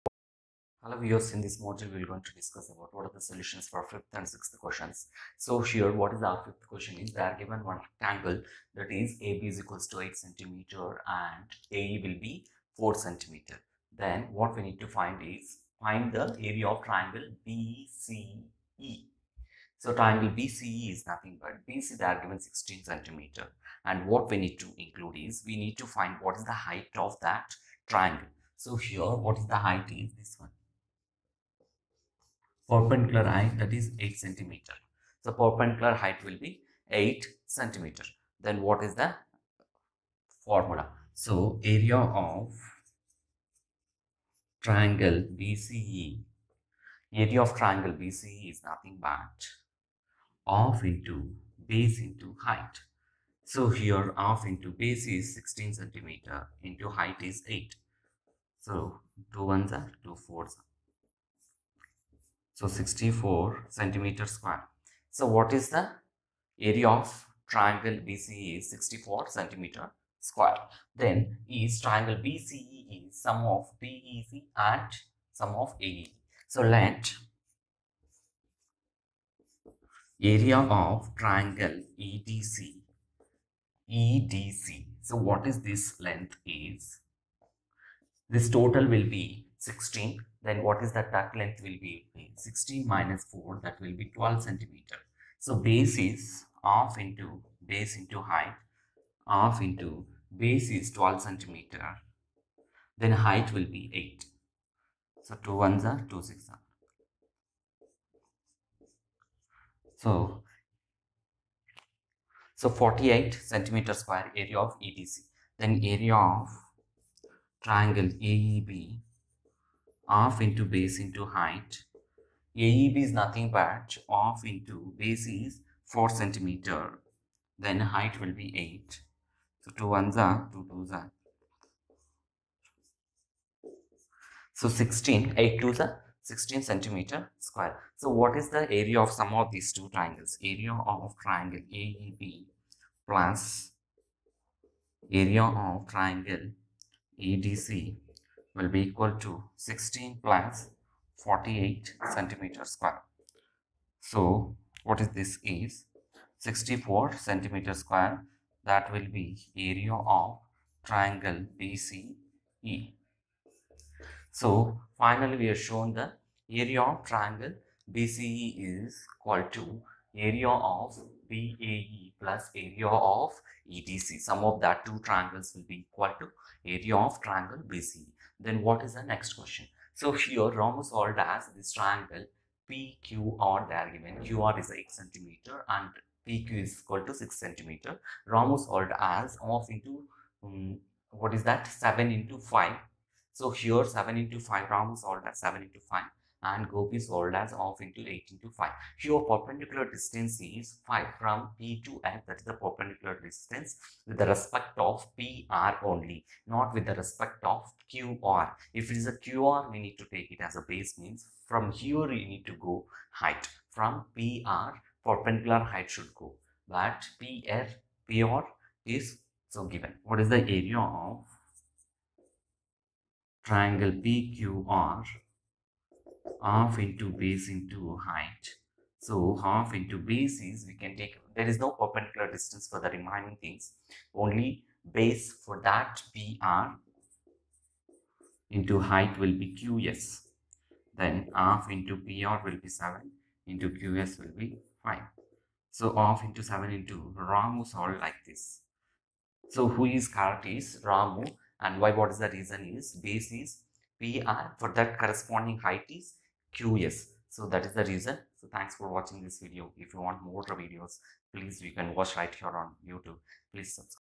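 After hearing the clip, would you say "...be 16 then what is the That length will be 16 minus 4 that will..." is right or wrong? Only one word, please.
right.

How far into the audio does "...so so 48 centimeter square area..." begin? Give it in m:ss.
1:50.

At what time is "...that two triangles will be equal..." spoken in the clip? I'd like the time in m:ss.
2:54.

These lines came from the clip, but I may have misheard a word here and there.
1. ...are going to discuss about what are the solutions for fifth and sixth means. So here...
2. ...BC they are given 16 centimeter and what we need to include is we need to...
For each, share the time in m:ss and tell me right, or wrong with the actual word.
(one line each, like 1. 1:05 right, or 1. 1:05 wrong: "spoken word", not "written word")
1. 0:02 wrong: "questions", not "means"
2. 0:21 right.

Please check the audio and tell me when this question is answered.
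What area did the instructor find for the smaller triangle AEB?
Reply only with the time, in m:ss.
2:16.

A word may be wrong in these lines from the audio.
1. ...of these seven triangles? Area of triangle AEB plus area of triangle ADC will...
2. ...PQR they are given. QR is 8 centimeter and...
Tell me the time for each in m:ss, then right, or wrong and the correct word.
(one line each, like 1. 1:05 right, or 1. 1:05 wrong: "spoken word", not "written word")
1. 2:19 wrong: "two", not "seven"
2. 3:02 right.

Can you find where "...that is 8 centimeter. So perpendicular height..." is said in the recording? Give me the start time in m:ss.
0:33.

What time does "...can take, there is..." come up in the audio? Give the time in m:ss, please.
3:50.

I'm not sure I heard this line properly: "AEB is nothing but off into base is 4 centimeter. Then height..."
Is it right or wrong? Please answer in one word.
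right.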